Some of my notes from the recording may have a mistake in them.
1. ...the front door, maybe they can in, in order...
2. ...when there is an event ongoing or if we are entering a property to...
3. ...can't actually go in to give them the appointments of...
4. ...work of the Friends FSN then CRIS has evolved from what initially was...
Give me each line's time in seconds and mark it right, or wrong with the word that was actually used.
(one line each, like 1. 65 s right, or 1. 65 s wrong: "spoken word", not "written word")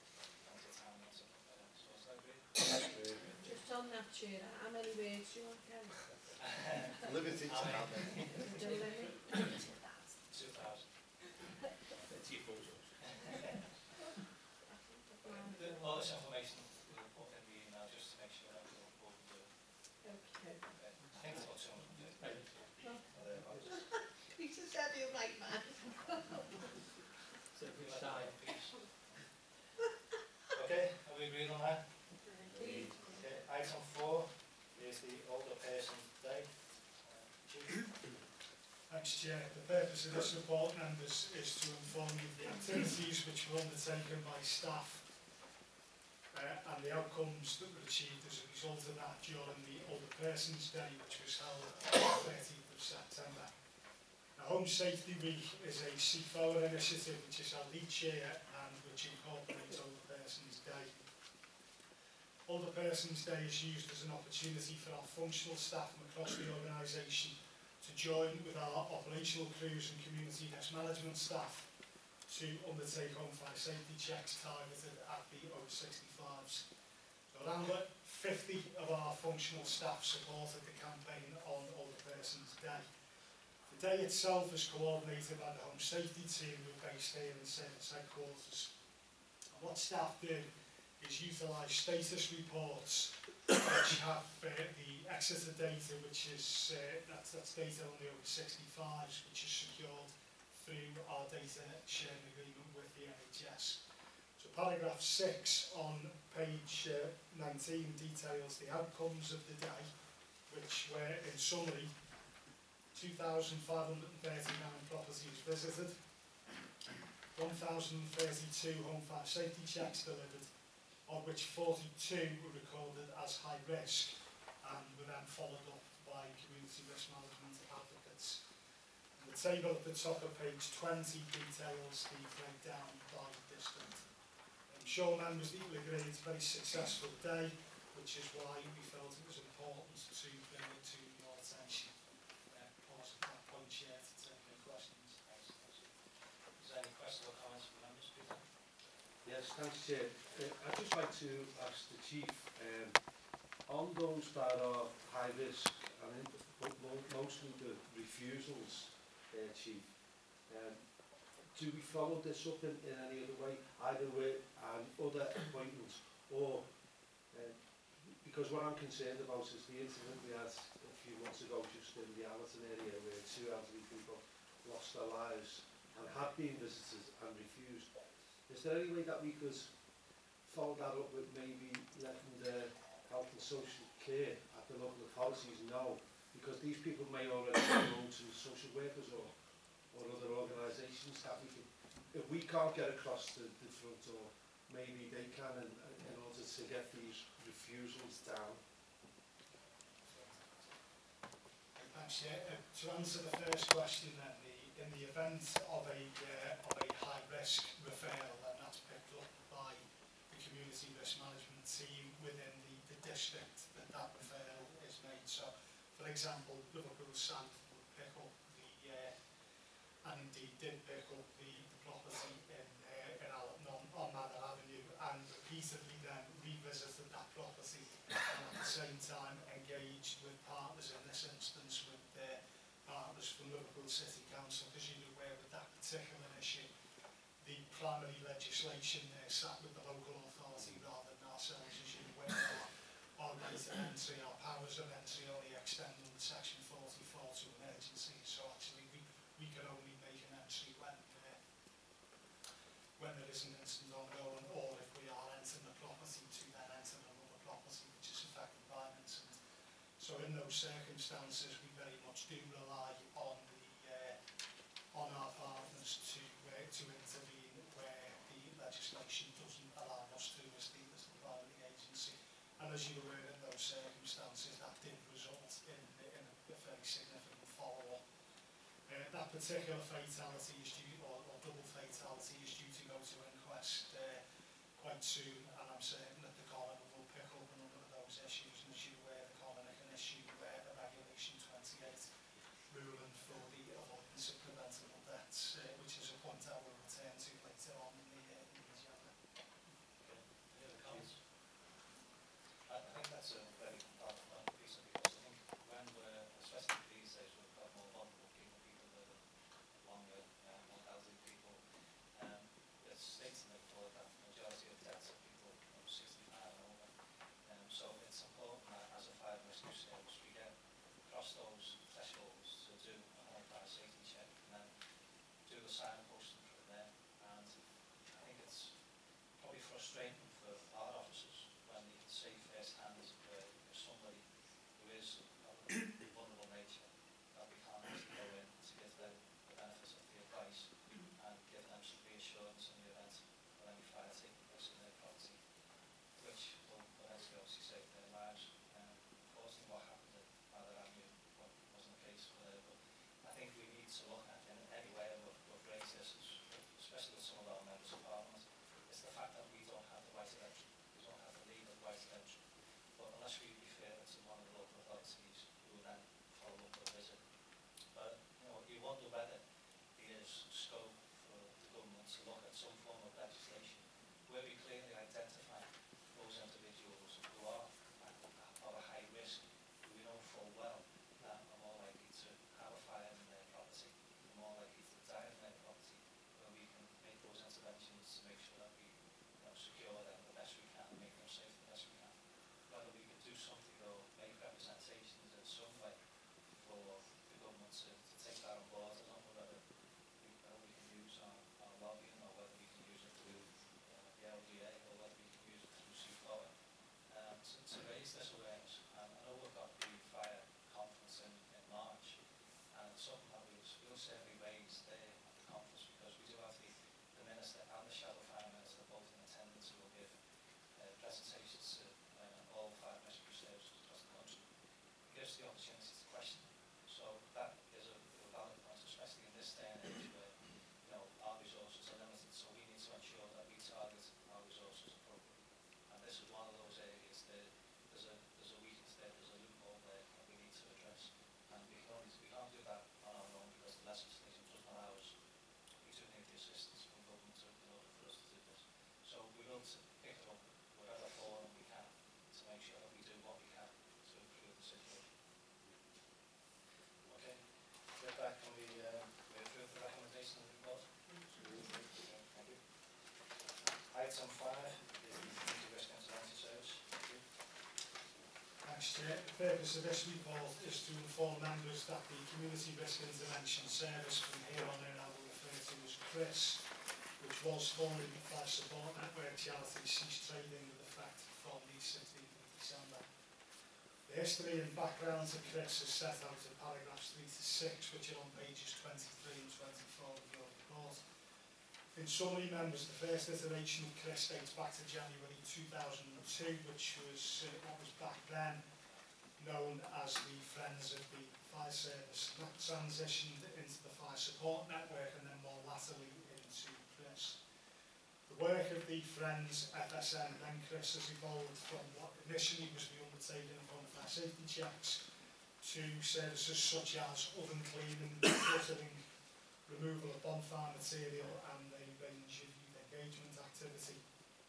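1. 193 s right
2. 253 s wrong: "incident", not "event"
3. 337 s wrong: "benefits", not "appointments"
4. 508 s right.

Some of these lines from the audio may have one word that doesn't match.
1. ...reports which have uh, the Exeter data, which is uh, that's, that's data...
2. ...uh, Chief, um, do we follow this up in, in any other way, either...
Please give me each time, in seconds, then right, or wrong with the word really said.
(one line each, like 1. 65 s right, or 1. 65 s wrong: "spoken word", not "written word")
1. 92 s right
2. 159 s right.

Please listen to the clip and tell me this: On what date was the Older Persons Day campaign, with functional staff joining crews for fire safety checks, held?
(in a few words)
13th of September.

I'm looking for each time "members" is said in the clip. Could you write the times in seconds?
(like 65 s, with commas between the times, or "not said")
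40 s, 135 s, 147 s, 471 s, 492 s.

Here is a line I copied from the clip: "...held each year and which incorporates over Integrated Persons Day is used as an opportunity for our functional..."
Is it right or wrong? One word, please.
wrong.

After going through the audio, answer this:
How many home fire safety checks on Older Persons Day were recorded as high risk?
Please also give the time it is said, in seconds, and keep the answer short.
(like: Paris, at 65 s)
42, at 121 s.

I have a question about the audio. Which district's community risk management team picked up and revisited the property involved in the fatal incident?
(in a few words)
Liverpool South.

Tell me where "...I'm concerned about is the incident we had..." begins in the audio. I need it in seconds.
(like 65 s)
168 s.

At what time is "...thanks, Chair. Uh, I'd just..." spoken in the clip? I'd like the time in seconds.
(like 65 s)
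149 s.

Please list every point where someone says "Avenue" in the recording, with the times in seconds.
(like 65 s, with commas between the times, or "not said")
224 s, 350 s.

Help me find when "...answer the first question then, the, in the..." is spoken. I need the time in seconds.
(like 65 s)
202 s.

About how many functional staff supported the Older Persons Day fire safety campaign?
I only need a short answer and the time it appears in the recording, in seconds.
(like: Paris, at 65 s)
50, at 77 s.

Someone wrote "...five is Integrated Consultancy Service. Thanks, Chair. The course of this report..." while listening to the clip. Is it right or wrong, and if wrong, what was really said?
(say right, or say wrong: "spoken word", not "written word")
wrong: "purpose", not "course".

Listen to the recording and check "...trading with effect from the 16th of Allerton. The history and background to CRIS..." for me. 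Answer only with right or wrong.
wrong.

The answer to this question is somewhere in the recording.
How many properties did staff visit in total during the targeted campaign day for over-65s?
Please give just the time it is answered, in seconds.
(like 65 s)
112 s.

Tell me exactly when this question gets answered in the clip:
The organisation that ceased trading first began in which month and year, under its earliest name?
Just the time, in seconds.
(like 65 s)
494 s.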